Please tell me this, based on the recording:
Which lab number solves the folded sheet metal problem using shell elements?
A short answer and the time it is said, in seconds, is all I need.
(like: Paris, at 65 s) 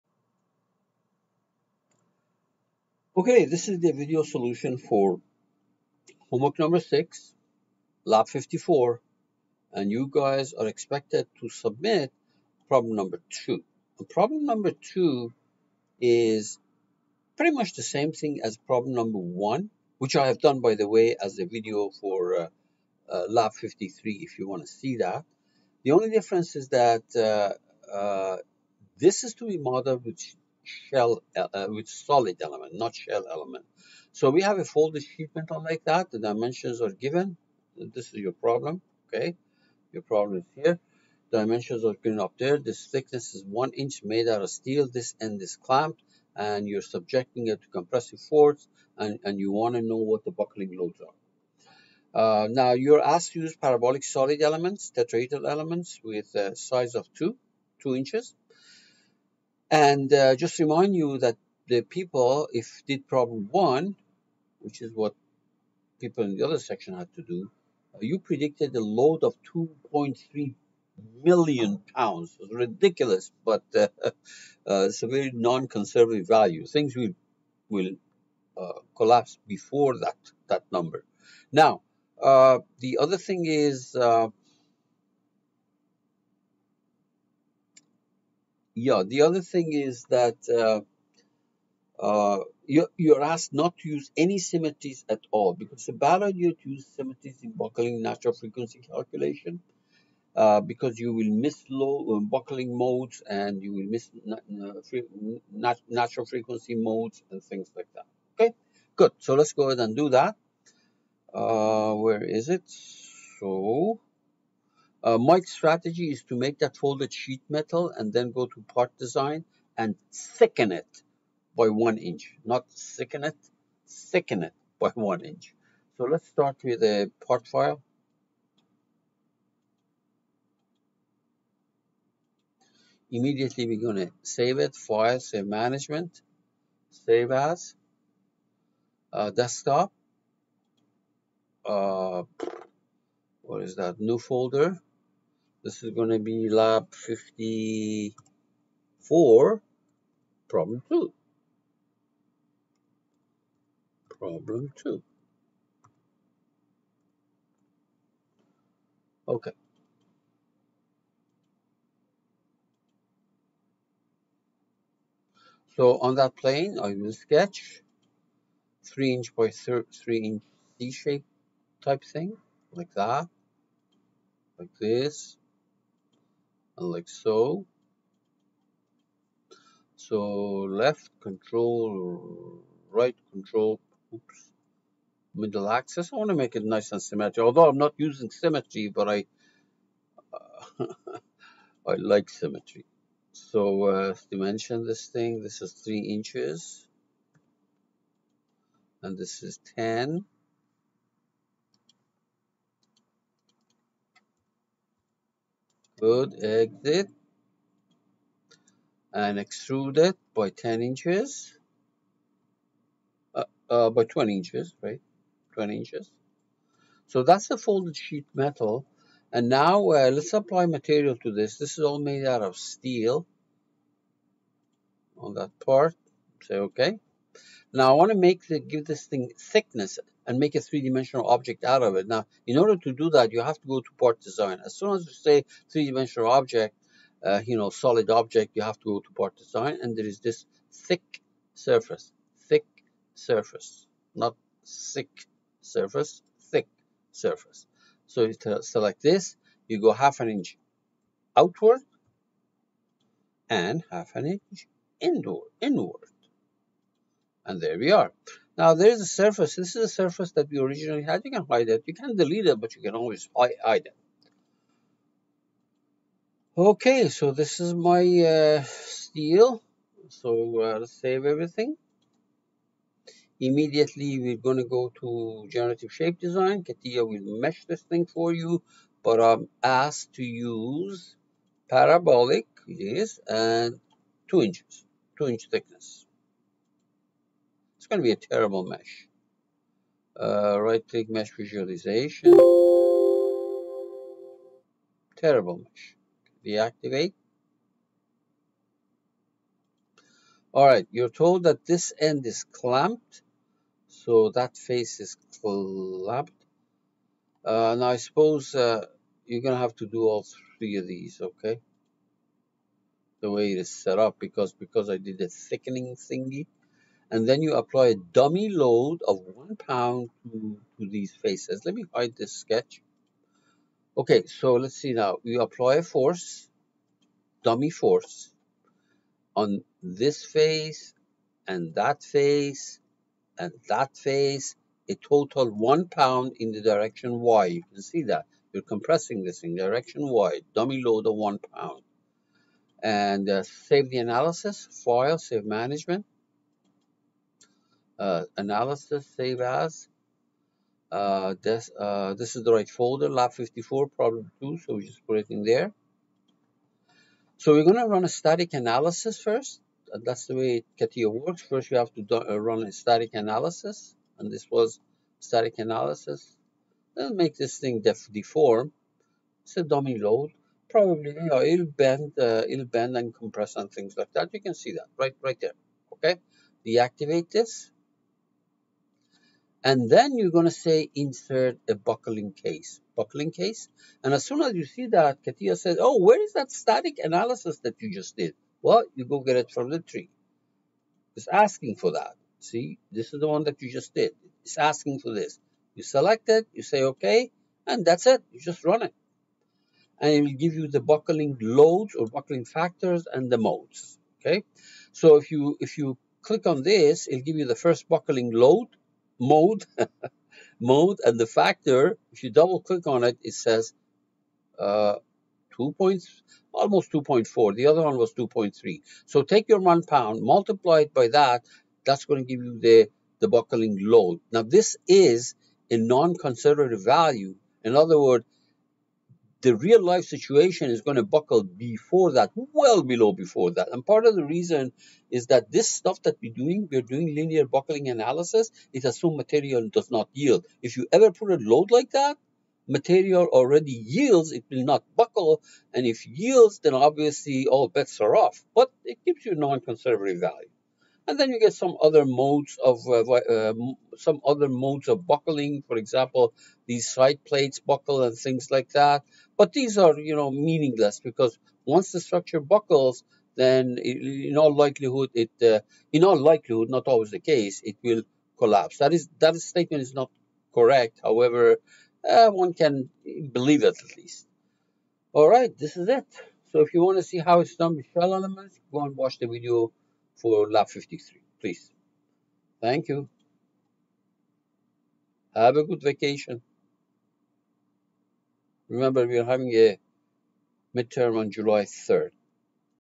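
53, at 23 s.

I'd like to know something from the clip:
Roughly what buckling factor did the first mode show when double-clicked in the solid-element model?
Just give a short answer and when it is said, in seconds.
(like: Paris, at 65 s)
2.4, at 416 s.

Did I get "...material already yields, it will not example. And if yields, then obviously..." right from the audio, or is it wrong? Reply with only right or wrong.
wrong.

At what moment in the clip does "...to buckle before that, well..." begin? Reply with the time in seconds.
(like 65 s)
430 s.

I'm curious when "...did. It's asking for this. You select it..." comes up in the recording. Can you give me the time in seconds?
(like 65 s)
393 s.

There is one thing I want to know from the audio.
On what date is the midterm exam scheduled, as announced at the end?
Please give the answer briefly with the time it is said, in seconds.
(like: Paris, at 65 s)
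July 3rd, at 491 s.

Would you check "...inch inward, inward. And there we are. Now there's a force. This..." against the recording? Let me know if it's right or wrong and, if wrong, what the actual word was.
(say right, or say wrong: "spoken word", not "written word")
wrong: "surface", not "force".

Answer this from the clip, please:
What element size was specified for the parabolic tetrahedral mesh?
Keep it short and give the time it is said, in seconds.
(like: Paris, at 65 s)
2 inches, at 57 s.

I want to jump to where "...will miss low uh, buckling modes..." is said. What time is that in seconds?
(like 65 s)
101 s.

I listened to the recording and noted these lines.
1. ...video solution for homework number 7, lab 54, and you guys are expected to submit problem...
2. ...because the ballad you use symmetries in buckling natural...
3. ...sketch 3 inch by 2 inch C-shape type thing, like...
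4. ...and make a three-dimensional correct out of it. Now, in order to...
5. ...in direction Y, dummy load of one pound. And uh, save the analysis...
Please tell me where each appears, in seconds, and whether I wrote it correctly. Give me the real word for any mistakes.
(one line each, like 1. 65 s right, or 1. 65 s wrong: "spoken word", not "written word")
1. 3 s wrong: "6", not "7"
2. 95 s right
3. 167 s wrong: "3", not "2"
4. 230 s wrong: "object", not "correct"
5. 339 s right.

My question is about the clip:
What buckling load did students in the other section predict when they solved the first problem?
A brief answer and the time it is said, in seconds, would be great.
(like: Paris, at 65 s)
2.3 million pounds, at 69 s.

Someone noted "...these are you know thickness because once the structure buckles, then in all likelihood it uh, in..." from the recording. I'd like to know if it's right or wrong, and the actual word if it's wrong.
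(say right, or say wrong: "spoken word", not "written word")
wrong: "meaningless", not "thickness".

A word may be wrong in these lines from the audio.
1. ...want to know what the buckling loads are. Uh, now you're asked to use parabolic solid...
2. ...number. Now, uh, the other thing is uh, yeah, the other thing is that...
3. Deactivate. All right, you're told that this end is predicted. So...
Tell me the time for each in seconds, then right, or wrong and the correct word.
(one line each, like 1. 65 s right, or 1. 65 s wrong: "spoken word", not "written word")
1. 49 s right
2. 80 s right
3. 296 s wrong: "clamped", not "predicted".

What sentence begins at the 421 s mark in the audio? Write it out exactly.
That's going to give you the, the buckling load.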